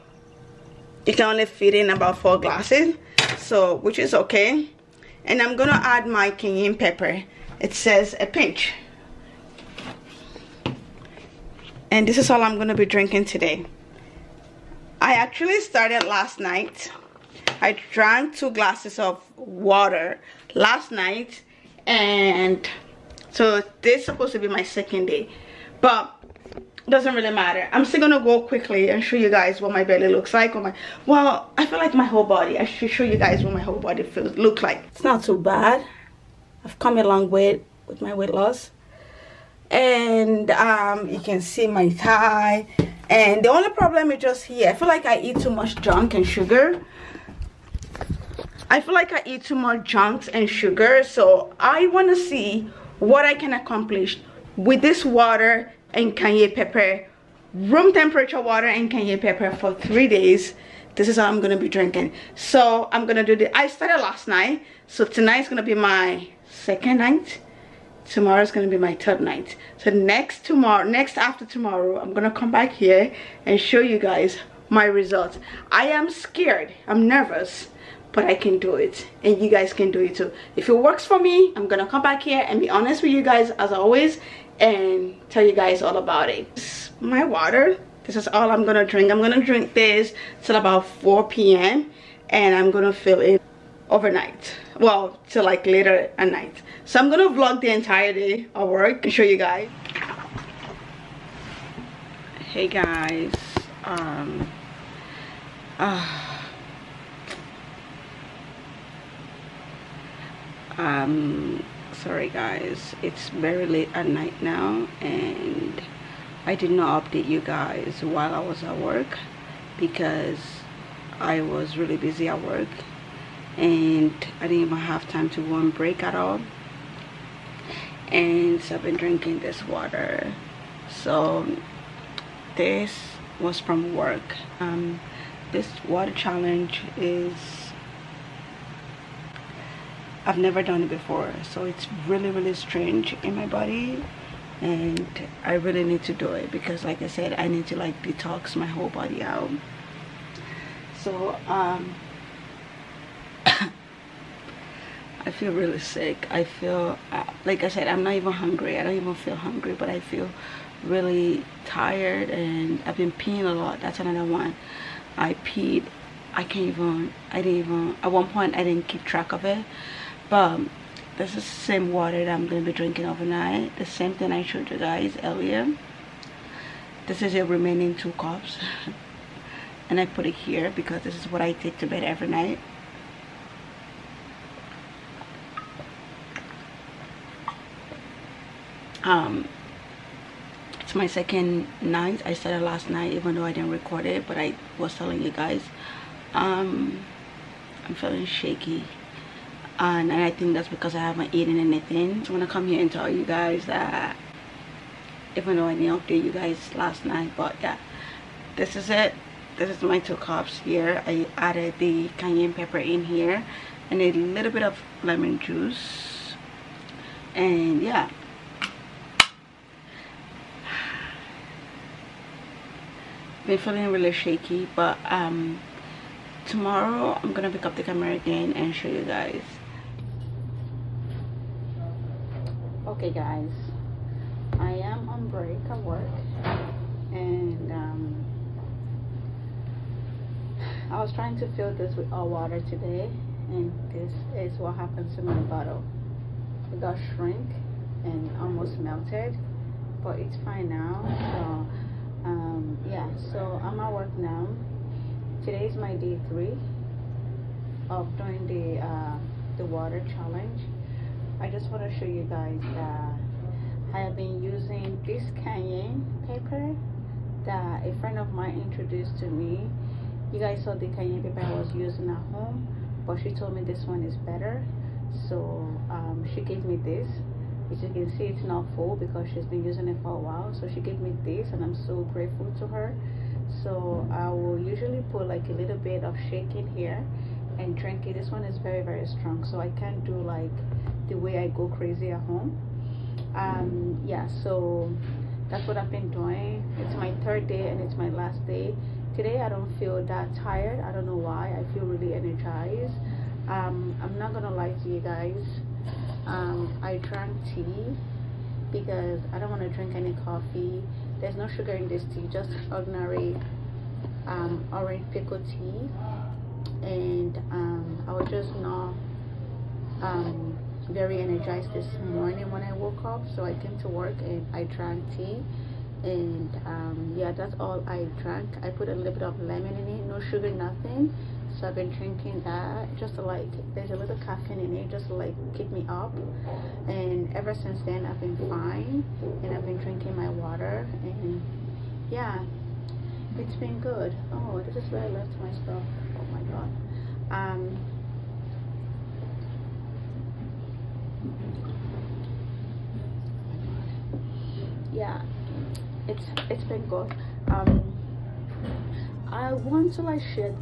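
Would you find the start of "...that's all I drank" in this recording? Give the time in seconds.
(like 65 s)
327 s.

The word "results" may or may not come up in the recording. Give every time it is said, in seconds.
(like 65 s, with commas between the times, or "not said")
74 s.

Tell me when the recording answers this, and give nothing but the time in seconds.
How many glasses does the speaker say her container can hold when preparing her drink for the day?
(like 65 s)
2 s.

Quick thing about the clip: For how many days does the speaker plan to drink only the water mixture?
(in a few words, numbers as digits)
3.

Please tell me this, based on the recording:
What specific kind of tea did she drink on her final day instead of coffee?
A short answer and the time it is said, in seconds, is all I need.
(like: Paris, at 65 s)
Orange pekoe, at 314 s.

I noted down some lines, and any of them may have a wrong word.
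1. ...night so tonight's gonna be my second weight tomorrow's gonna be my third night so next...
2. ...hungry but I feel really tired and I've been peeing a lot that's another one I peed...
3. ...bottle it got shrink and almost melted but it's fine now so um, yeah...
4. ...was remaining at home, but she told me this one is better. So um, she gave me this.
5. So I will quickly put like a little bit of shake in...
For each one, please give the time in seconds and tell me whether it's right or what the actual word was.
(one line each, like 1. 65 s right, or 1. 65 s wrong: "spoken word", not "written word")
1. 64 s wrong: "night", not "weight"
2. 159 s right
3. 245 s right
4. 271 s wrong: "using", not "remaining"
5. 283 s wrong: "usually", not "quickly".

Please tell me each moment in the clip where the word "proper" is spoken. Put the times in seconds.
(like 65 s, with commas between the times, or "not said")
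not said.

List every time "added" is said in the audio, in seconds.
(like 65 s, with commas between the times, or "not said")
211 s.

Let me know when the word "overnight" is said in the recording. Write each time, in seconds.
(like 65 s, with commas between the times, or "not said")
93 s, 173 s.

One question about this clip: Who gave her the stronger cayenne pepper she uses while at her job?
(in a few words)
A friend.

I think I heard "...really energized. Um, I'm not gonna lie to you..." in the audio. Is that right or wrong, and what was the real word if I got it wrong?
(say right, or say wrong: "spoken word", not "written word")
right.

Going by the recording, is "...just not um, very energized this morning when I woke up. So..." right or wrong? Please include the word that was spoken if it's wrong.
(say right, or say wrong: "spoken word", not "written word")
right.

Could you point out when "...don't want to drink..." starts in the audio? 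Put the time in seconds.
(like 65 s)
309 s.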